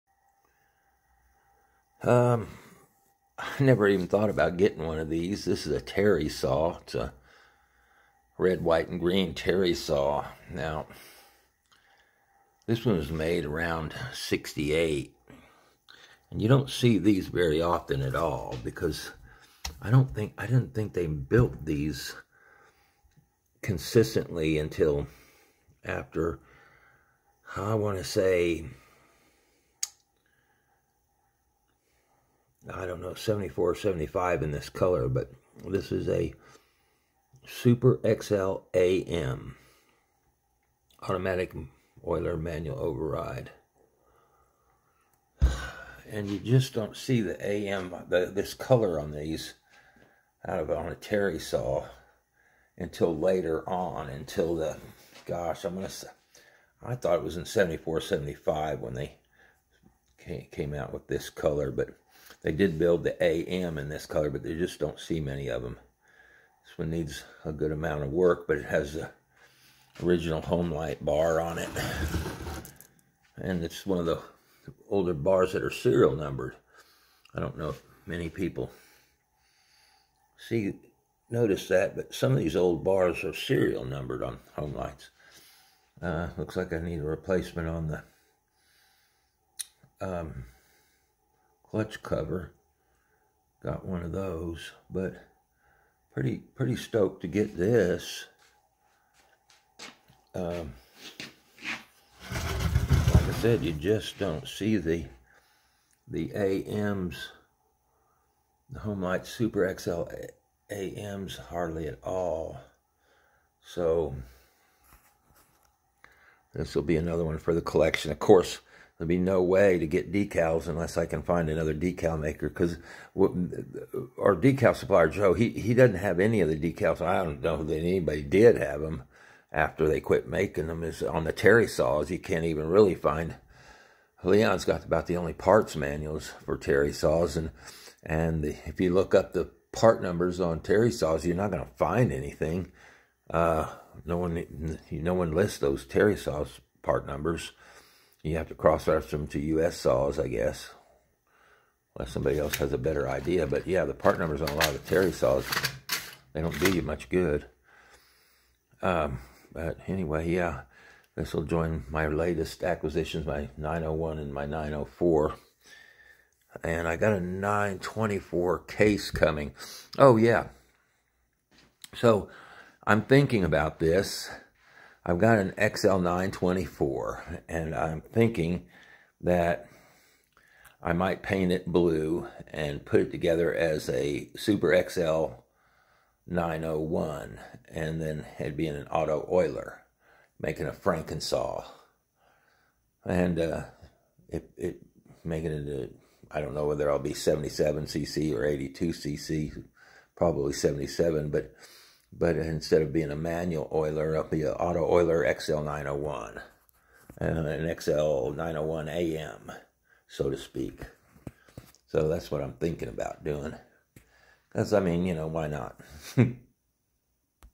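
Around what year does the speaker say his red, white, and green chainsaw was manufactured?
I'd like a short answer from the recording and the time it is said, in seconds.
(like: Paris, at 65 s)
1968, at 14 s.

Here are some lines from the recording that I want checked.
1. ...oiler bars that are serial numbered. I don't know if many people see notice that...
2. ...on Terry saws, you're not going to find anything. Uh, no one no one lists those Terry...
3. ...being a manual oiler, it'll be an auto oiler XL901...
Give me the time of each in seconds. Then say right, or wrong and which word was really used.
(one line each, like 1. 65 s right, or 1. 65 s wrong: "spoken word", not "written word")
1. 74 s wrong: "older", not "oiler"
2. 140 s right
3. 202 s right.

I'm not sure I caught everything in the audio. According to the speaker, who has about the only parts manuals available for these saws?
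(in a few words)
Leon.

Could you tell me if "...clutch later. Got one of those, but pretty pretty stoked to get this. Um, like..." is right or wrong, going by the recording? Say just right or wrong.
wrong.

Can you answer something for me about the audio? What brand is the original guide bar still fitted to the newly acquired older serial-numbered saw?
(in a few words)
Homelite.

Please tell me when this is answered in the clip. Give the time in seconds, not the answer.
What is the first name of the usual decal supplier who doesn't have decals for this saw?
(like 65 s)
125 s.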